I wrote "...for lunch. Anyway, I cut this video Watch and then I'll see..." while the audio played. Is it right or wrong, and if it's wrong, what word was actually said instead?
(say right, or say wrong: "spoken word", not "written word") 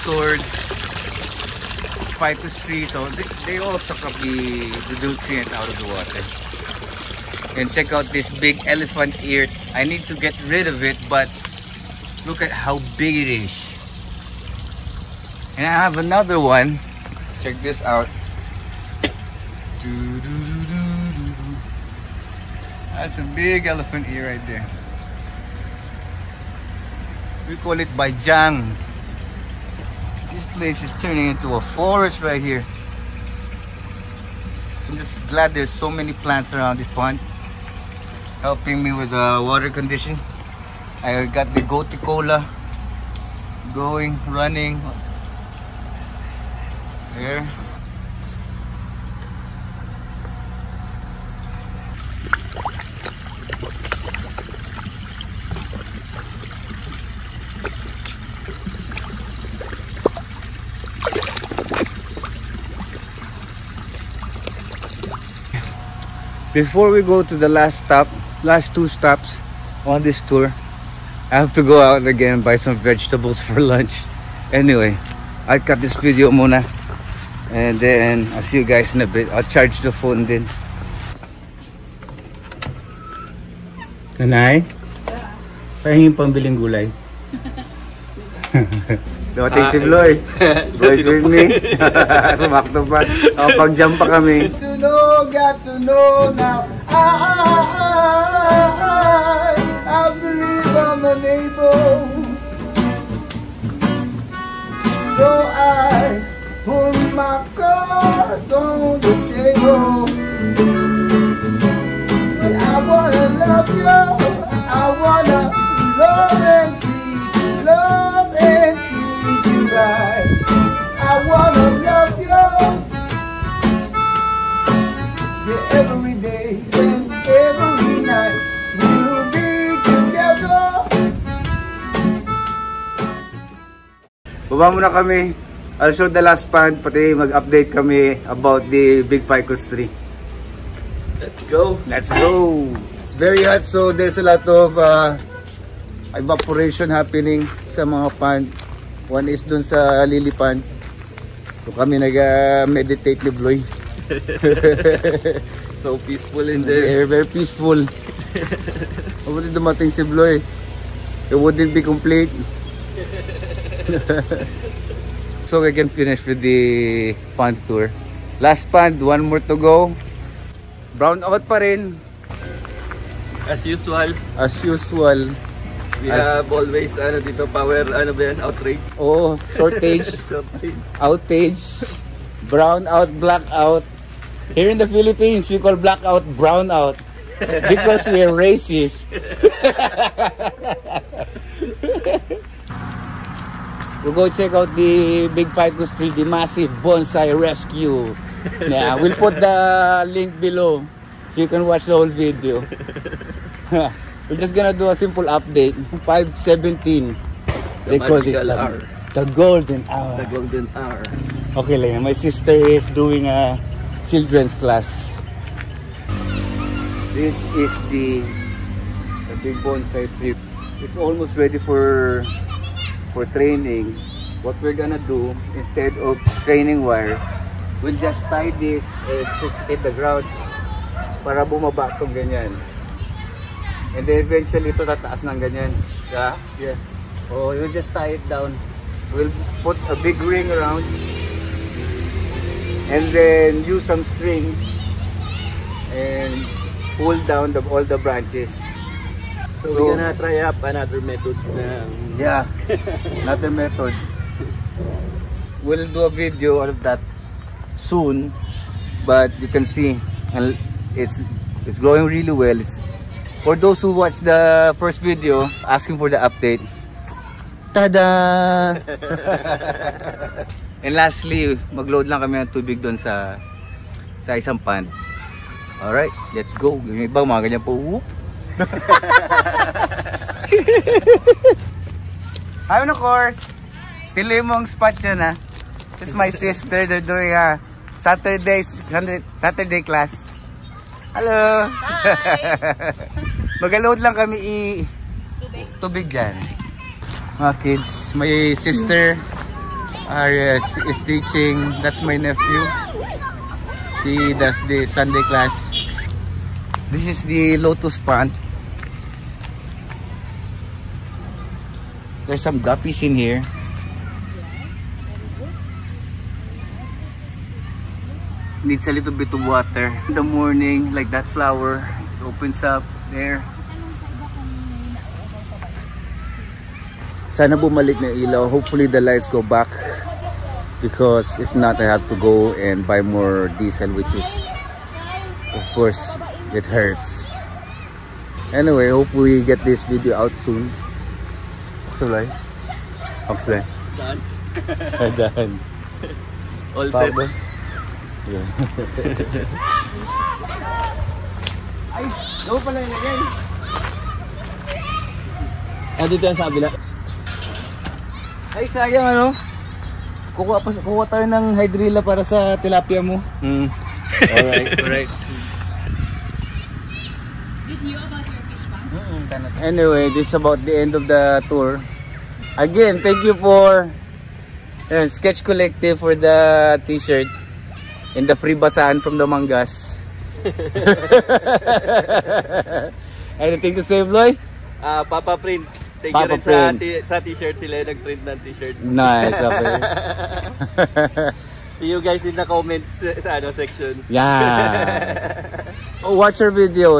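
wrong: "Mona", not "Watch".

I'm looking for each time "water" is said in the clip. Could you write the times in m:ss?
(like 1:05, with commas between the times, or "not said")
0:05, 0:39, 5:19.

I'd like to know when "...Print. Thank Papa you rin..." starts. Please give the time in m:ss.
6:25.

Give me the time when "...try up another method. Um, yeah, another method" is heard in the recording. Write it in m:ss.
4:10.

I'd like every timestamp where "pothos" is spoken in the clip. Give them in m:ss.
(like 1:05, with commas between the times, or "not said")
0:02.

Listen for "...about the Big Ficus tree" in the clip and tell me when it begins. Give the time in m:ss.
2:18.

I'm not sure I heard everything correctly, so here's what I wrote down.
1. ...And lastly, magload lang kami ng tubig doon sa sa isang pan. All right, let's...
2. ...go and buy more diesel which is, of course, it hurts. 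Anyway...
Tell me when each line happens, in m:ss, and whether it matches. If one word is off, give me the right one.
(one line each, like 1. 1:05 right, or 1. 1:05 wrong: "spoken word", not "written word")
1. 4:30 right
2. 5:32 right.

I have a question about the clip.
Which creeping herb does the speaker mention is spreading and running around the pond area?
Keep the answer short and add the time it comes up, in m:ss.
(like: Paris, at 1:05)
gotu kola, at 0:41.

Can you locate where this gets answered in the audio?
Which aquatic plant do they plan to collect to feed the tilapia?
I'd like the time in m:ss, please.
6:01.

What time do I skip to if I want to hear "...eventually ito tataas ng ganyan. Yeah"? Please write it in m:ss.
3:54.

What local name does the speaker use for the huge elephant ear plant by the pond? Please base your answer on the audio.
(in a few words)
Baijang.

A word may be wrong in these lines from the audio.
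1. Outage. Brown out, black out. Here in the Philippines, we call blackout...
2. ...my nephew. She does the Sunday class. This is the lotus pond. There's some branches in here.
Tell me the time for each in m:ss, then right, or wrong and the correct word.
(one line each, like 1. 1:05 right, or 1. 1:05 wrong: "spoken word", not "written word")
1. 3:00 right
2. 5:02 wrong: "guppies", not "branches".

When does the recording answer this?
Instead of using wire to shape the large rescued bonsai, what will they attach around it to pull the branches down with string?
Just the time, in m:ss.
4:00.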